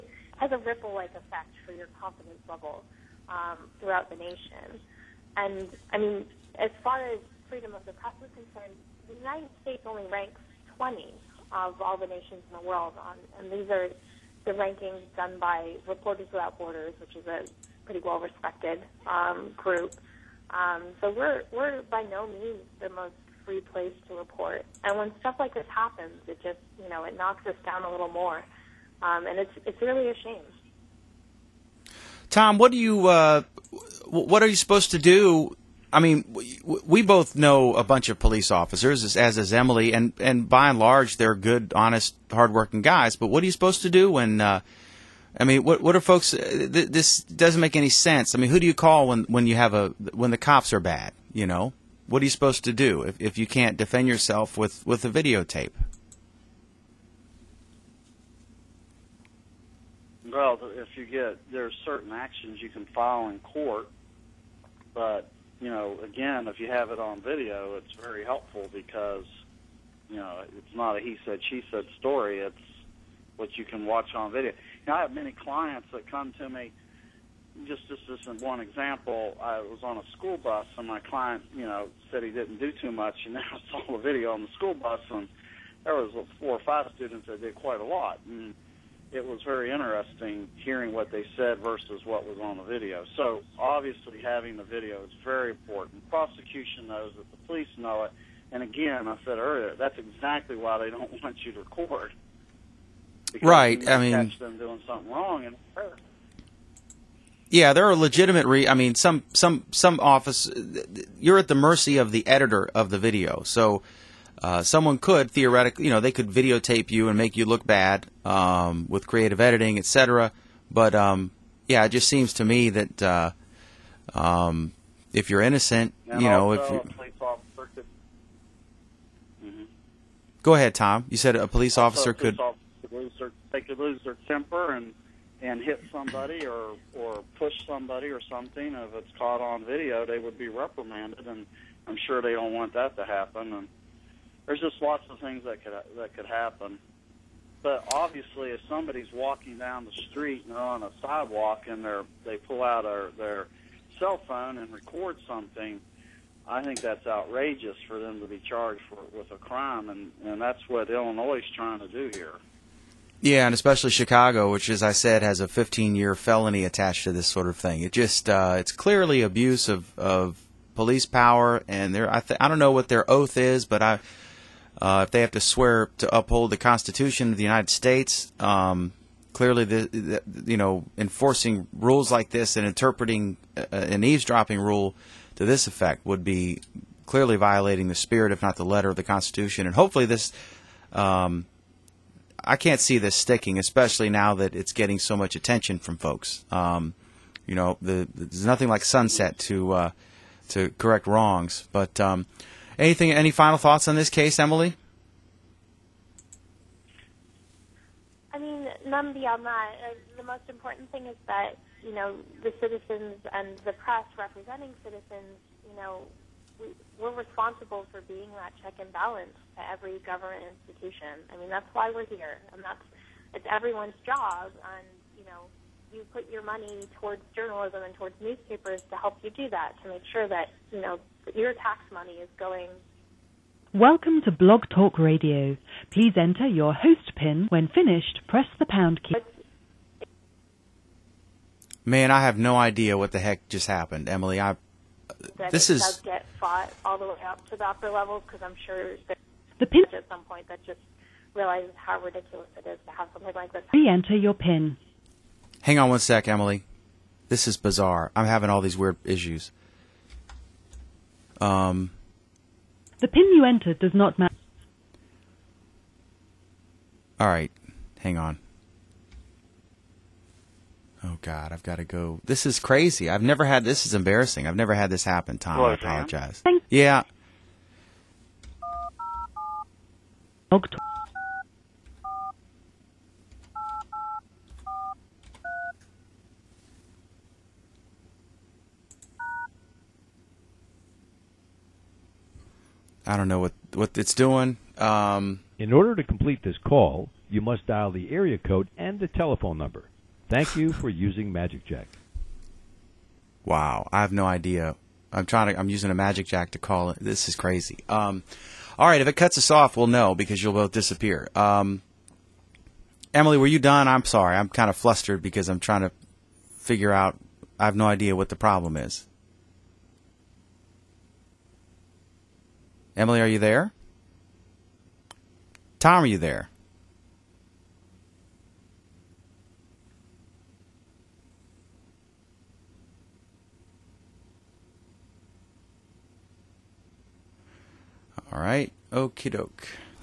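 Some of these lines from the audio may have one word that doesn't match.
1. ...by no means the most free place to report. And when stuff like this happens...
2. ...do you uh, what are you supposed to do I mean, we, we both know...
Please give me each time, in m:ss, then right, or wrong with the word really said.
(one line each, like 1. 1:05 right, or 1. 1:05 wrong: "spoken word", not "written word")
1. 0:21 right
2. 0:32 right.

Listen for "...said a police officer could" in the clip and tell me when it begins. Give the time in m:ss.
2:11.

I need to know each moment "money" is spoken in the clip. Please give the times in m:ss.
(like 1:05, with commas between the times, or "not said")
3:46, 3:51.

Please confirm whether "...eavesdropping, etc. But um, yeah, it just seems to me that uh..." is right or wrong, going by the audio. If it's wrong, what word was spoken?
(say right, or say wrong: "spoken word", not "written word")
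wrong: "editing", not "eavesdropping".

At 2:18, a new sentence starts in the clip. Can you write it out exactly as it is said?
If it's caught on video, they would be reprimanded, and I'm sure they don't want that to happen.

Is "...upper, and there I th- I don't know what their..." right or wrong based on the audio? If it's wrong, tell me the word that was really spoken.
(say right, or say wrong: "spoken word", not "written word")
wrong: "power", not "upper".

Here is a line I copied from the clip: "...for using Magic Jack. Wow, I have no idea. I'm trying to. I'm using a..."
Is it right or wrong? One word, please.
right.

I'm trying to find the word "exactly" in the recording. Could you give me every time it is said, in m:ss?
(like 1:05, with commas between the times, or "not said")
1:39.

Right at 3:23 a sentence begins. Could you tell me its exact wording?
Any final thoughts on this case, Emily?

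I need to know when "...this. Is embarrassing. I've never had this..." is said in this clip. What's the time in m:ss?
4:33.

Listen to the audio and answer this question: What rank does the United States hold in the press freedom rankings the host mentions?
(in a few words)
20.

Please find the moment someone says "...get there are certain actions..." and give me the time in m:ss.
1:01.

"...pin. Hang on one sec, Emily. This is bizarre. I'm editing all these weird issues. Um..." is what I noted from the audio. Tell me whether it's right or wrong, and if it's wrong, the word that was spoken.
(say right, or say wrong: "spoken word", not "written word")
wrong: "having", not "editing".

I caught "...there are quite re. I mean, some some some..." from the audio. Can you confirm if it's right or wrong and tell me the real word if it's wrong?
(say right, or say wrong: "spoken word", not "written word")
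wrong: "legitimate", not "quite".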